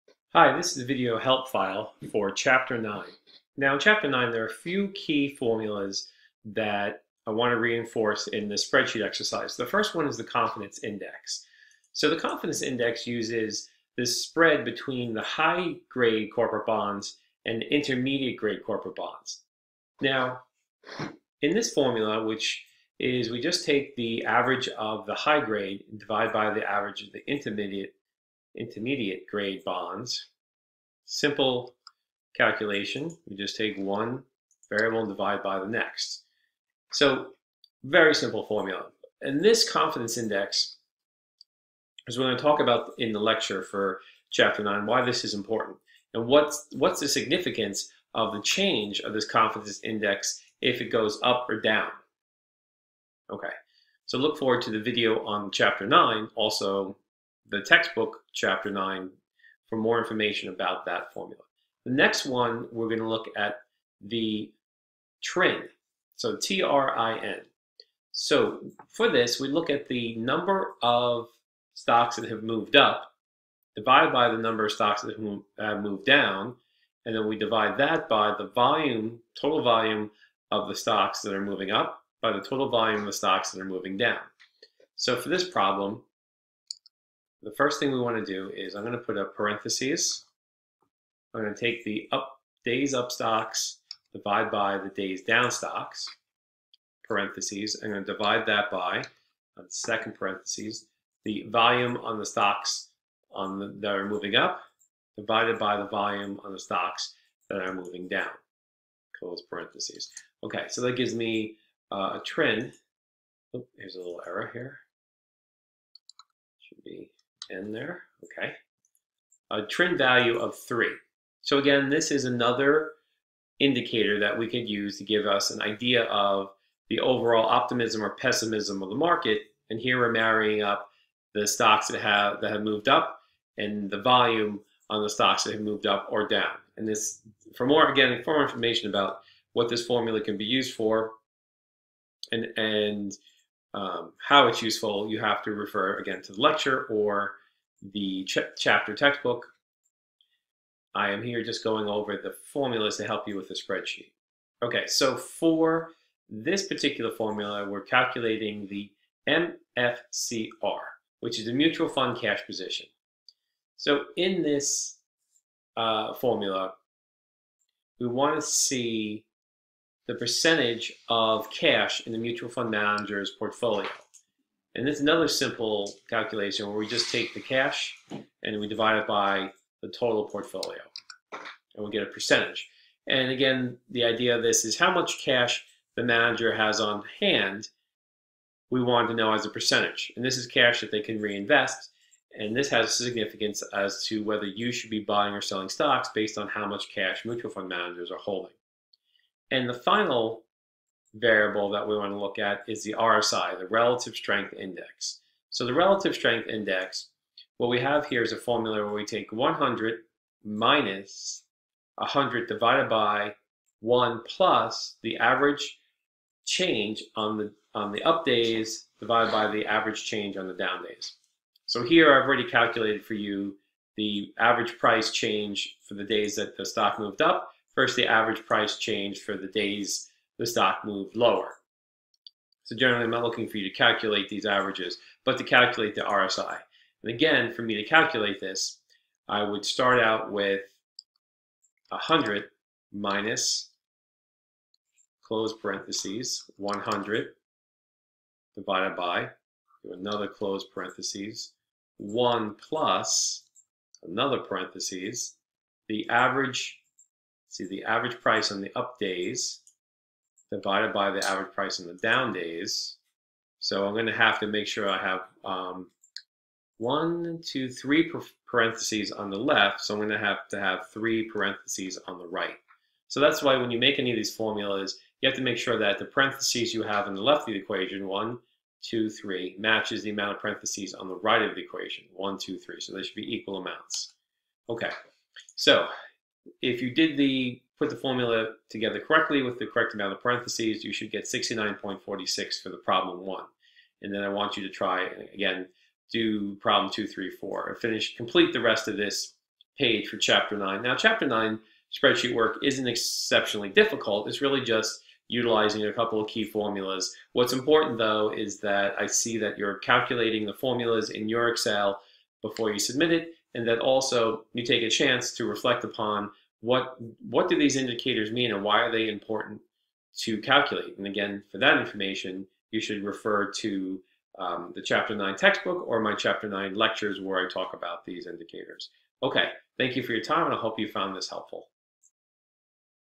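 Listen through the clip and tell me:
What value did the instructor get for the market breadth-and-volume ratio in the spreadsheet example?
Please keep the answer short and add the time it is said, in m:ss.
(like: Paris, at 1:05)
3, at 1:59.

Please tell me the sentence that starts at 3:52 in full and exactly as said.
So generally, I'm not looking for you to calculate these averages, but to calculate the RSI.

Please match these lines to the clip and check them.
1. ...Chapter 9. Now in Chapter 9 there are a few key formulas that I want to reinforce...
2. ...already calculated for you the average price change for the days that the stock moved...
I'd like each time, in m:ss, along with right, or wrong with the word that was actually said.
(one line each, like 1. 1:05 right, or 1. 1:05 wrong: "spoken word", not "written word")
1. 0:02 right
2. 3:42 right.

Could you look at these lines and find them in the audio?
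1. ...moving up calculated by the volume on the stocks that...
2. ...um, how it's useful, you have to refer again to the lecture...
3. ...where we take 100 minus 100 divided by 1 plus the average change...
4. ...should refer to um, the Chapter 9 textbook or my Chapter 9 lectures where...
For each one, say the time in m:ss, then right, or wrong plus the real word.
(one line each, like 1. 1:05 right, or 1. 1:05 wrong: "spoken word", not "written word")
1. 1:44 wrong: "divided", not "calculated"
2. 2:23 right
3. 3:28 right
4. 5:22 right.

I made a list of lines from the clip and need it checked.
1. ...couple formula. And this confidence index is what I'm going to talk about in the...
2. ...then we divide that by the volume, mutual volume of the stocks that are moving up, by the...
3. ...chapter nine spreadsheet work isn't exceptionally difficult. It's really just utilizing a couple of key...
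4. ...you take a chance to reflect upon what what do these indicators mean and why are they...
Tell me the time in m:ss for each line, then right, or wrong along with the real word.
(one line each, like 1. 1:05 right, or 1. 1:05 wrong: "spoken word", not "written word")
1. 0:38 wrong: "simple", not "couple"
2. 1:17 wrong: "total", not "mutual"
3. 5:00 right
4. 5:14 right.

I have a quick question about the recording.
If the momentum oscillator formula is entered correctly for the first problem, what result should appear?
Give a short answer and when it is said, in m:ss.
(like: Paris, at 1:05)
69.46, at 4:51.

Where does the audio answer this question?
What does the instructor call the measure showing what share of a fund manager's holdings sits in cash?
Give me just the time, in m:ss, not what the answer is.
2:41.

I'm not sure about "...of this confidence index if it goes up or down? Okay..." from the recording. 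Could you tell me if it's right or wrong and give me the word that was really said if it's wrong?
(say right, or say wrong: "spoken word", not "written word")
right.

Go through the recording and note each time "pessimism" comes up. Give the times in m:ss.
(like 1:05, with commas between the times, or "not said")
2:08.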